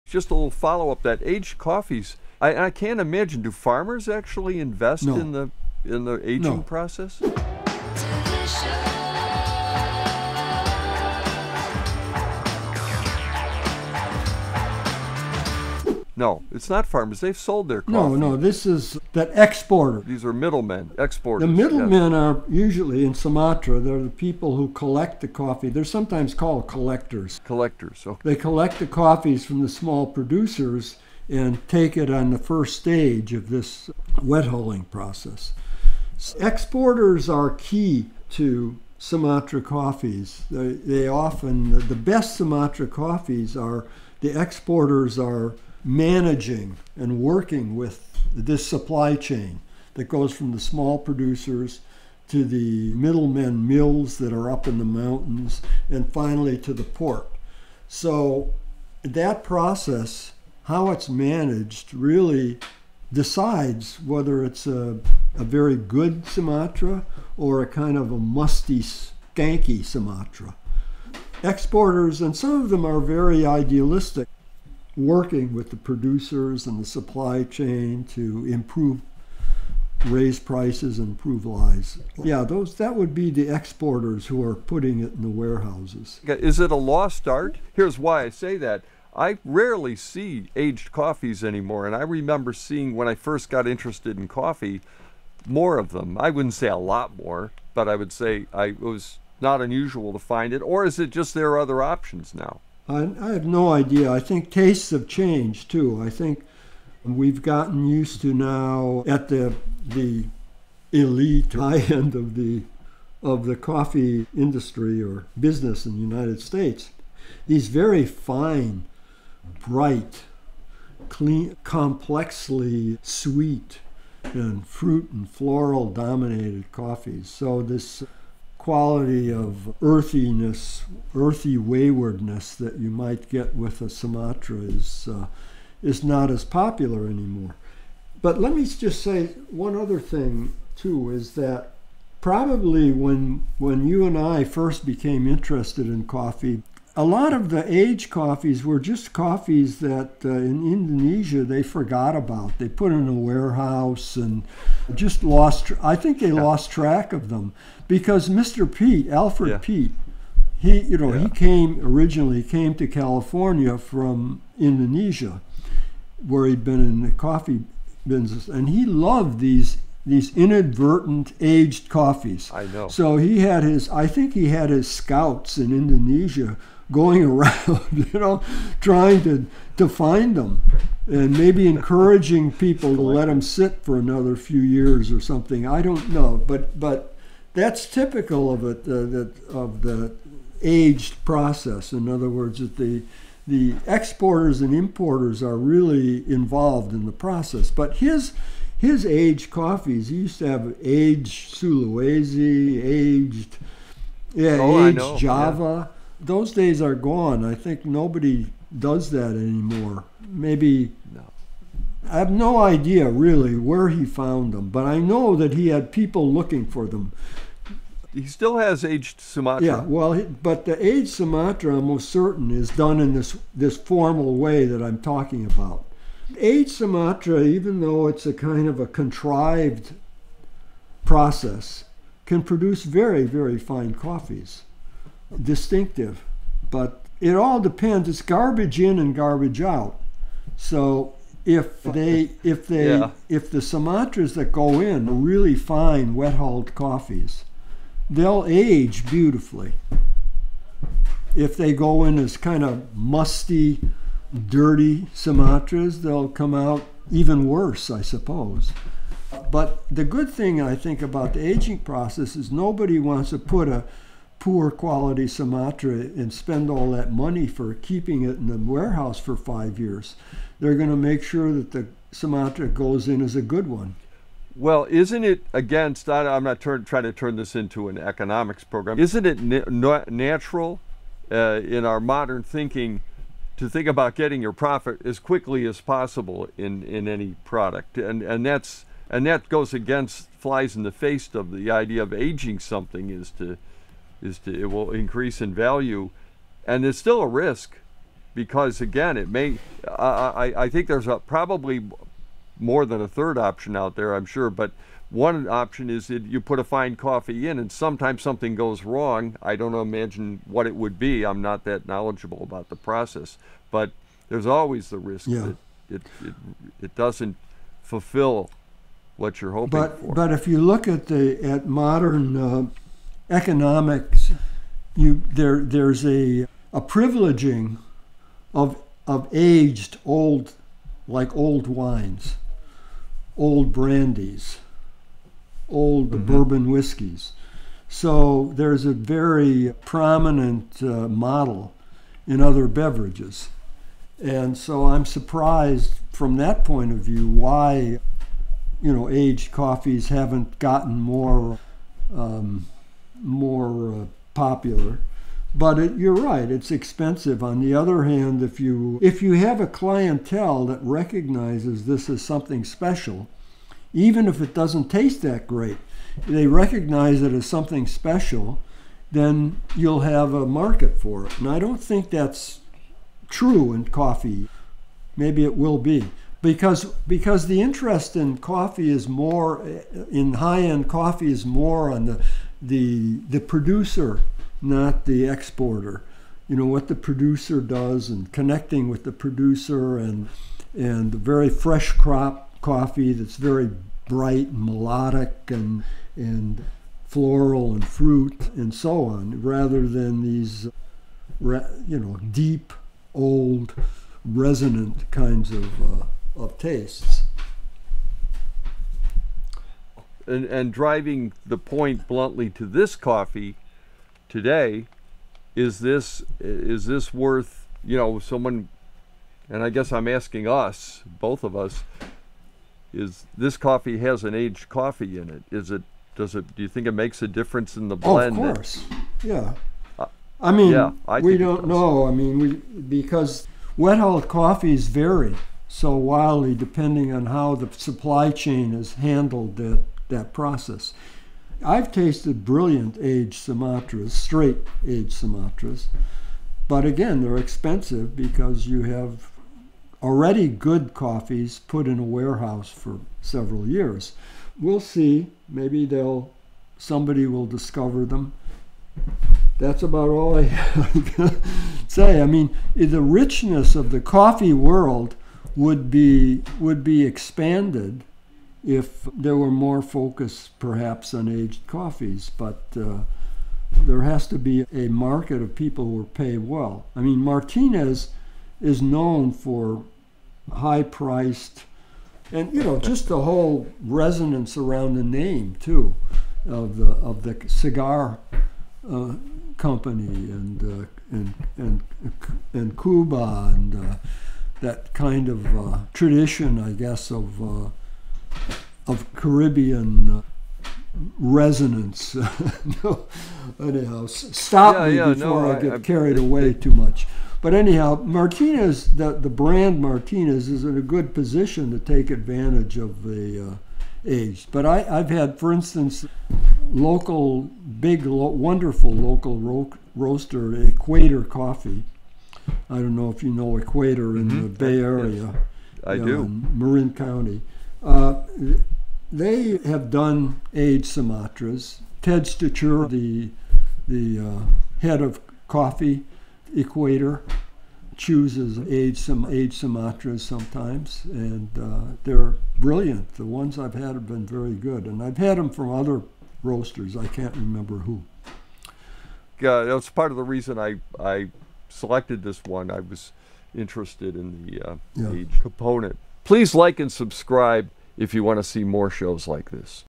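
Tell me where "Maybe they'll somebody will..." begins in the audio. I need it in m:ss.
7:35.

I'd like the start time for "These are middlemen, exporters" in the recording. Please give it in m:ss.
0:20.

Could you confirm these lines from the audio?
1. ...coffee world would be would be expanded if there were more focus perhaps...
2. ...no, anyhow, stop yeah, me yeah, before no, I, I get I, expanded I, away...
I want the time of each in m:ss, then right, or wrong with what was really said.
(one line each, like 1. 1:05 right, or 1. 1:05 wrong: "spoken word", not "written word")
1. 7:43 right
2. 8:22 wrong: "carried", not "expanded".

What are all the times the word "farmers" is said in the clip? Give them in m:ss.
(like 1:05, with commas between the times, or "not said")
0:03, 0:16.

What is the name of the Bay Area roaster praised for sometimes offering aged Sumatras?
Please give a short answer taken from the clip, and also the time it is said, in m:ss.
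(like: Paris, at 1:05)
Equator Coffee, at 8:40.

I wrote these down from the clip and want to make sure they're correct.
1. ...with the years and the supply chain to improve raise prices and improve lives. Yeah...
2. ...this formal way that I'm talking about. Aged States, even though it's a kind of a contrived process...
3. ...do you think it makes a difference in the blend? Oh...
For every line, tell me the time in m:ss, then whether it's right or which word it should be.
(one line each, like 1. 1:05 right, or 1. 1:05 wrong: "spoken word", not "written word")
1. 1:15 wrong: "producers", not "years"
2. 3:43 wrong: "Sumatra", not "States"
3. 7:06 right.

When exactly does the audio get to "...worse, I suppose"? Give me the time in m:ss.
4:17.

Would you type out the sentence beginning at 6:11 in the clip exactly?
And I don't think that's true in coffee.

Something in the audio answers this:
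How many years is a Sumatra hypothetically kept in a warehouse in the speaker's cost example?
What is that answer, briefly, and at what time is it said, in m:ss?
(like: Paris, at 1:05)
5, at 4:29.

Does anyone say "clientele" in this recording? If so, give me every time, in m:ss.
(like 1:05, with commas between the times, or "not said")
5:59.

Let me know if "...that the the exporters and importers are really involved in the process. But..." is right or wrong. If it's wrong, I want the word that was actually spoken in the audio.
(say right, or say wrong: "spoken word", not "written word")
right.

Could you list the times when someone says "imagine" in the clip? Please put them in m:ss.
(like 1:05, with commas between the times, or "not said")
0:02, 5:09.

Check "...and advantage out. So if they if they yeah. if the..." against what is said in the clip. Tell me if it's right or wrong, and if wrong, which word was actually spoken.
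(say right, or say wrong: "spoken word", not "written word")
wrong: "garbage", not "advantage".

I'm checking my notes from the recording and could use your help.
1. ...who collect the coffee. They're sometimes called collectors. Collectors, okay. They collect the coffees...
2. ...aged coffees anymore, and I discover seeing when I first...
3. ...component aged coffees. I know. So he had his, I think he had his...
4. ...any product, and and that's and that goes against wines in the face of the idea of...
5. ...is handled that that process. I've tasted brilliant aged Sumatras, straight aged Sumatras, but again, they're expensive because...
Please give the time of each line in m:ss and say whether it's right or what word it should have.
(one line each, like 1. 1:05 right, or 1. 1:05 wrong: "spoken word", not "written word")
1. 0:24 right
2. 1:30 wrong: "remember", not "discover"
3. 2:50 wrong: "inadvertent", not "component"
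4. 4:47 wrong: "flies", not "wines"
5. 7:18 right.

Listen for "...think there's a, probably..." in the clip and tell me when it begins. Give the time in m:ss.
5:00.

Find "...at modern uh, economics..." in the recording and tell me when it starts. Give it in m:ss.
5:21.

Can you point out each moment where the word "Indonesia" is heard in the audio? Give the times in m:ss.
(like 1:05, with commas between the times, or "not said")
2:30, 2:44, 2:55.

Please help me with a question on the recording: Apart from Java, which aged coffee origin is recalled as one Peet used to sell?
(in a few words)
Sulawesi.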